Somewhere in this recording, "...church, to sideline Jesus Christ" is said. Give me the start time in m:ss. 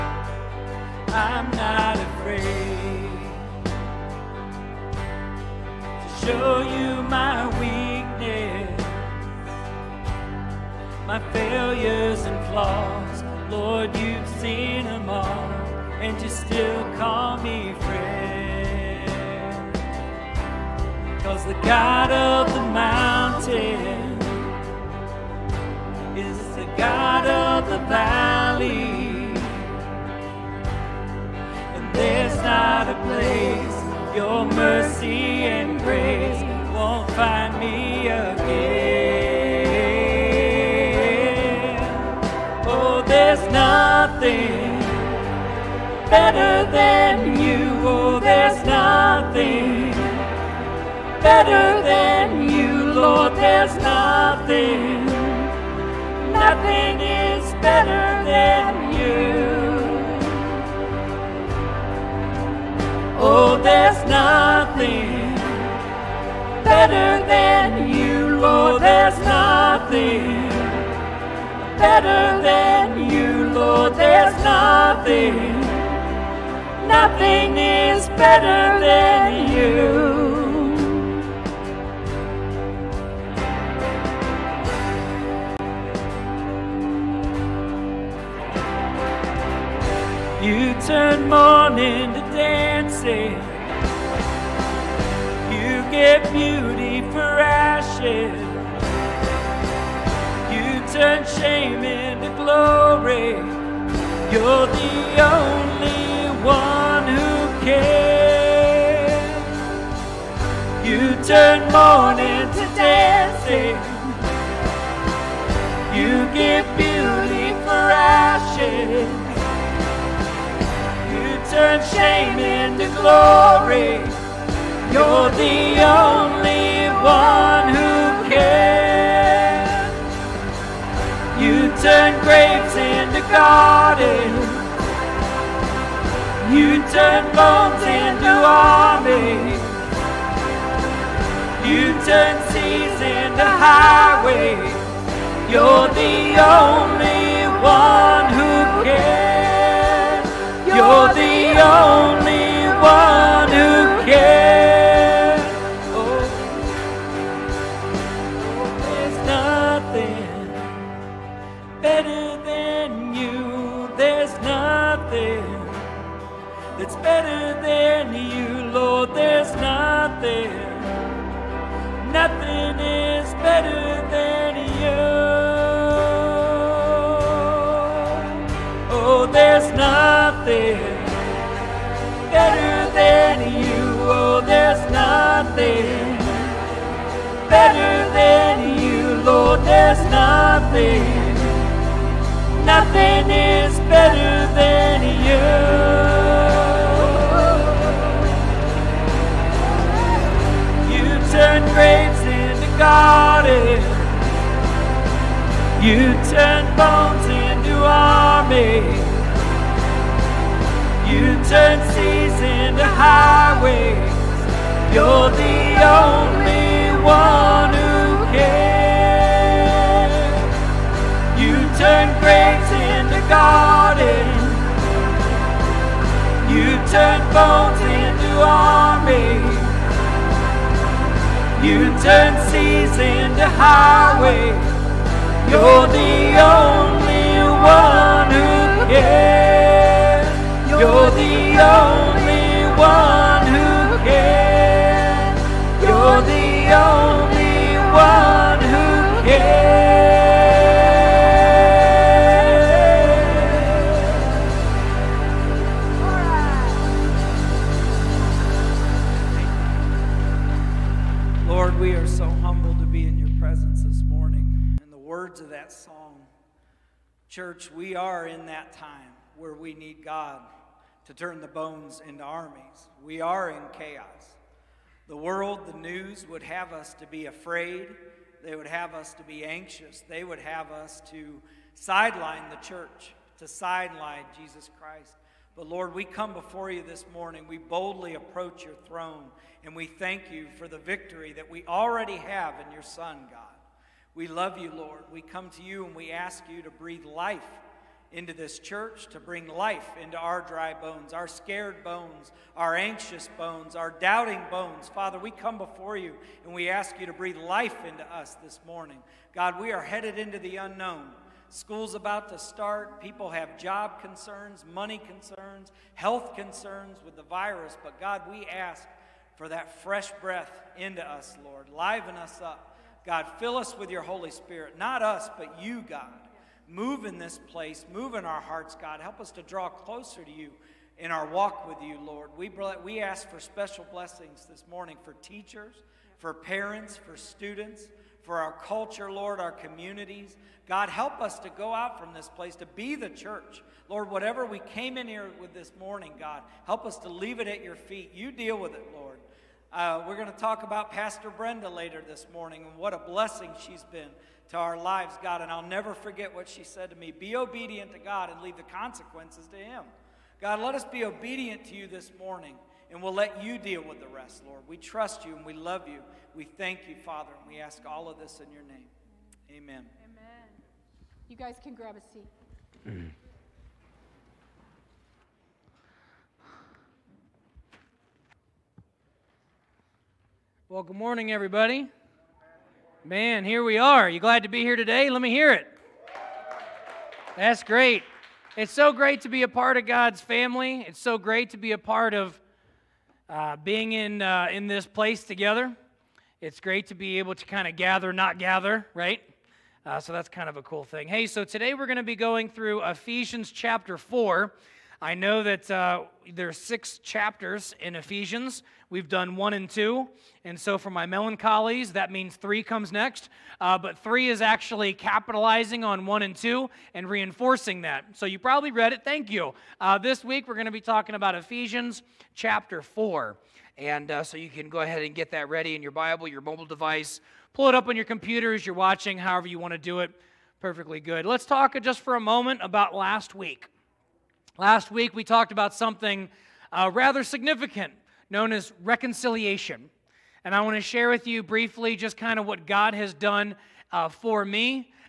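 4:42.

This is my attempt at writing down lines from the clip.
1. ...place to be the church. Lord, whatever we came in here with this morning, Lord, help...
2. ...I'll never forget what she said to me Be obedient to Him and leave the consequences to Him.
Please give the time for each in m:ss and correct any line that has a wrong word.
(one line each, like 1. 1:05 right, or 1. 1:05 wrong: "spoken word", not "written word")
1. 5:42 wrong: "God", not "Lord"
2. 5:55 wrong: "God", not "Him".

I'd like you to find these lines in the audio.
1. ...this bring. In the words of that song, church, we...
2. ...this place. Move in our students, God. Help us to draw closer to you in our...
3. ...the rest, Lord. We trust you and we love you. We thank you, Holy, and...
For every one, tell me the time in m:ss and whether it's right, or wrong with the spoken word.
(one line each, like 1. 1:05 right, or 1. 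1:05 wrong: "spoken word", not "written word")
1. 4:23 wrong: "morning", not "bring"
2. 5:27 wrong: "hearts", not "students"
3. 6:03 wrong: "Father", not "Holy".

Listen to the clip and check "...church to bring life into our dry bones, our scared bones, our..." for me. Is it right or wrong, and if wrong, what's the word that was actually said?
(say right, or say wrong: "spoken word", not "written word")
right.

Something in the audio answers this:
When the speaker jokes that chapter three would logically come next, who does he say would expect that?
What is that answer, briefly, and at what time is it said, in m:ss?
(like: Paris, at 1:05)
melancholies, at 6:51.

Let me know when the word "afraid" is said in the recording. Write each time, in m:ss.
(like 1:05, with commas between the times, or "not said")
4:37.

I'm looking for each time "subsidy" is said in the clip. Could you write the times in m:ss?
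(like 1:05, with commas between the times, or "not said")
not said.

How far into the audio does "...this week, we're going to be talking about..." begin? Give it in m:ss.
6:59.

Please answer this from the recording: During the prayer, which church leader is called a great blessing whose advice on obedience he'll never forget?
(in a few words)
Pastor Brenda.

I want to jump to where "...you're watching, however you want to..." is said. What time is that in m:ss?
7:08.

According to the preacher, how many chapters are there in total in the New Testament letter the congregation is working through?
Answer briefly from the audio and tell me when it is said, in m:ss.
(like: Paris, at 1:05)
6, at 6:46.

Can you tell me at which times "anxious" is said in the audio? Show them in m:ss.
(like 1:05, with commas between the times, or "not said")
4:39, 5:02.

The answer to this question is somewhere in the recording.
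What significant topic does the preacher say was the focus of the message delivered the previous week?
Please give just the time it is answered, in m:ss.
7:18.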